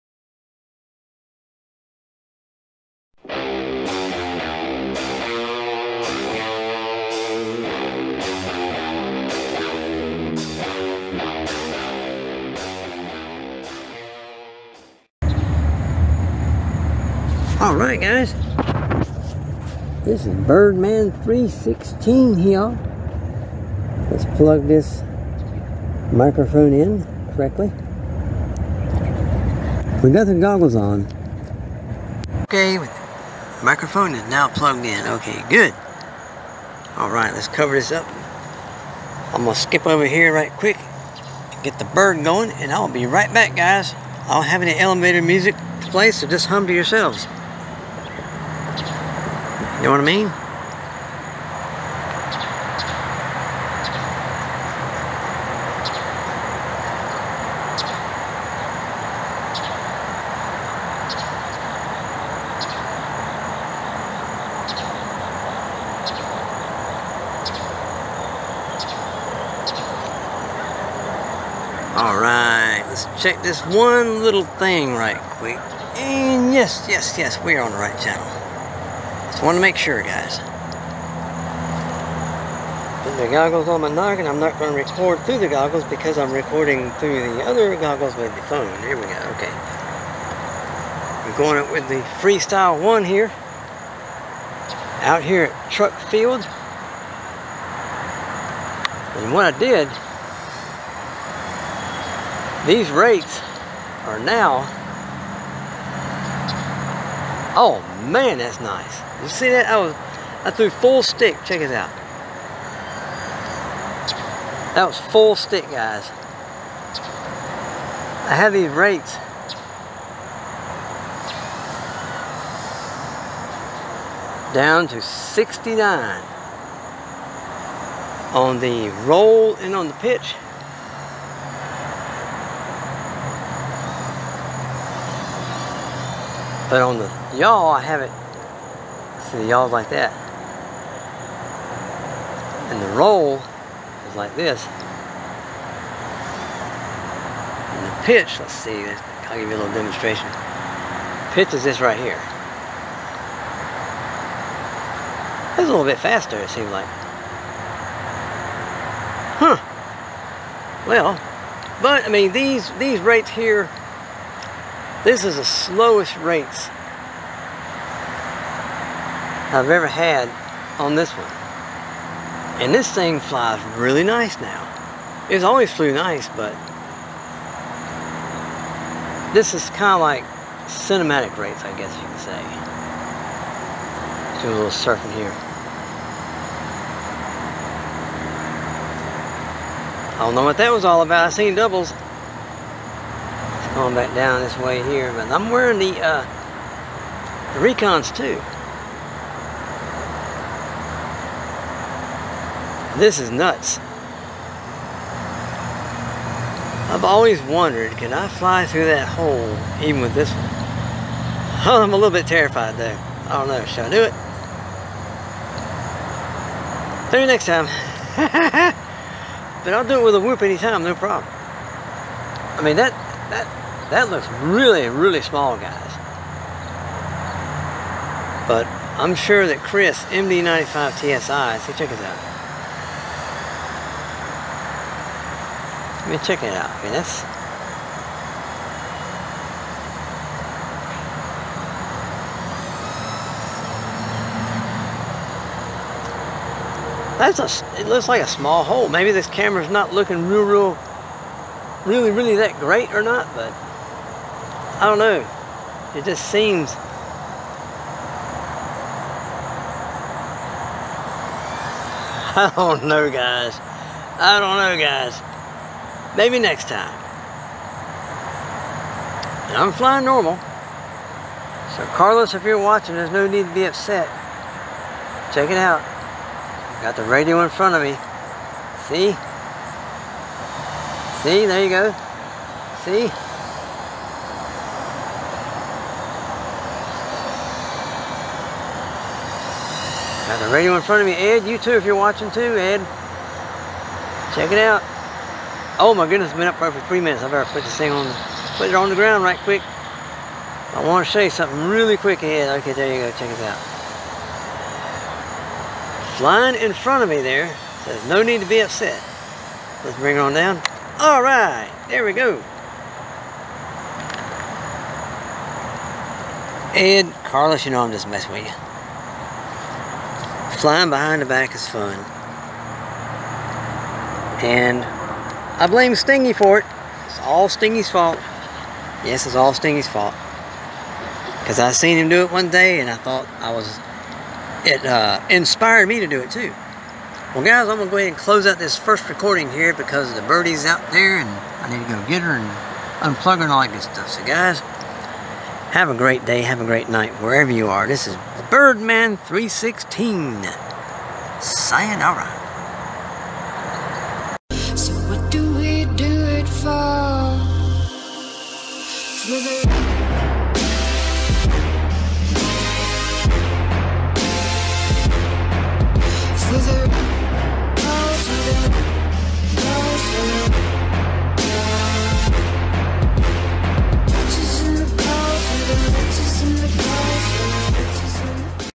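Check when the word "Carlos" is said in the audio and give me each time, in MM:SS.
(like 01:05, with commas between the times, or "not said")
04:31, 05:17.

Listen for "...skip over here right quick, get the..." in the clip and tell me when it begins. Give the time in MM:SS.
00:39.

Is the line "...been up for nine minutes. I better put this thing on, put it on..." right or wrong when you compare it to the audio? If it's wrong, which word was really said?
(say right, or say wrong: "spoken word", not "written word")
wrong: "three", not "nine".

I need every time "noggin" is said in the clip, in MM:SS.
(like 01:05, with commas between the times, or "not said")
01:23.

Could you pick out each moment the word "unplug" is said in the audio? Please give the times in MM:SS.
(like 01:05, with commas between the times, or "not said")
05:43.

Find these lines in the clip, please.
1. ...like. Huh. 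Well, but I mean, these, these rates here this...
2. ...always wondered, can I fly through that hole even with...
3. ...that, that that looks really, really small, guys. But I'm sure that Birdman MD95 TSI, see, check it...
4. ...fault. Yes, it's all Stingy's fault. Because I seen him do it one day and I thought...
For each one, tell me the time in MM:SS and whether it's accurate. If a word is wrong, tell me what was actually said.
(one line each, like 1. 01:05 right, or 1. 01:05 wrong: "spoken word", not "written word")
1. 02:36 right
2. 03:27 right
3. 03:42 wrong: "Chris", not "Birdman"
4. 05:27 right.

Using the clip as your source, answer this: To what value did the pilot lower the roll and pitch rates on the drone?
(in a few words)
69.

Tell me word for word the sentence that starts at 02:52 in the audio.
And this thing flies really nice now.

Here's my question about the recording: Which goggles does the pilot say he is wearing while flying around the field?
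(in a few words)
Recons.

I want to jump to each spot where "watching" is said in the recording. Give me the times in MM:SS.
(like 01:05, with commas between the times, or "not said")
04:32, 04:51.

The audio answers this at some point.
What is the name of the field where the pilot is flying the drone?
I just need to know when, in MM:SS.
01:35.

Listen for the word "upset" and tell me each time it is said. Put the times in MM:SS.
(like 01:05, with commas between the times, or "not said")
04:33, 05:08.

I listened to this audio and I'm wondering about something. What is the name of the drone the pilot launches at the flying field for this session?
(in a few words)
Freestyle 1.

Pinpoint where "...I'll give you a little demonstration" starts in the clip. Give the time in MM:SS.
02:29.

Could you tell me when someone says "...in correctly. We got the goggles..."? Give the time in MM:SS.
00:26.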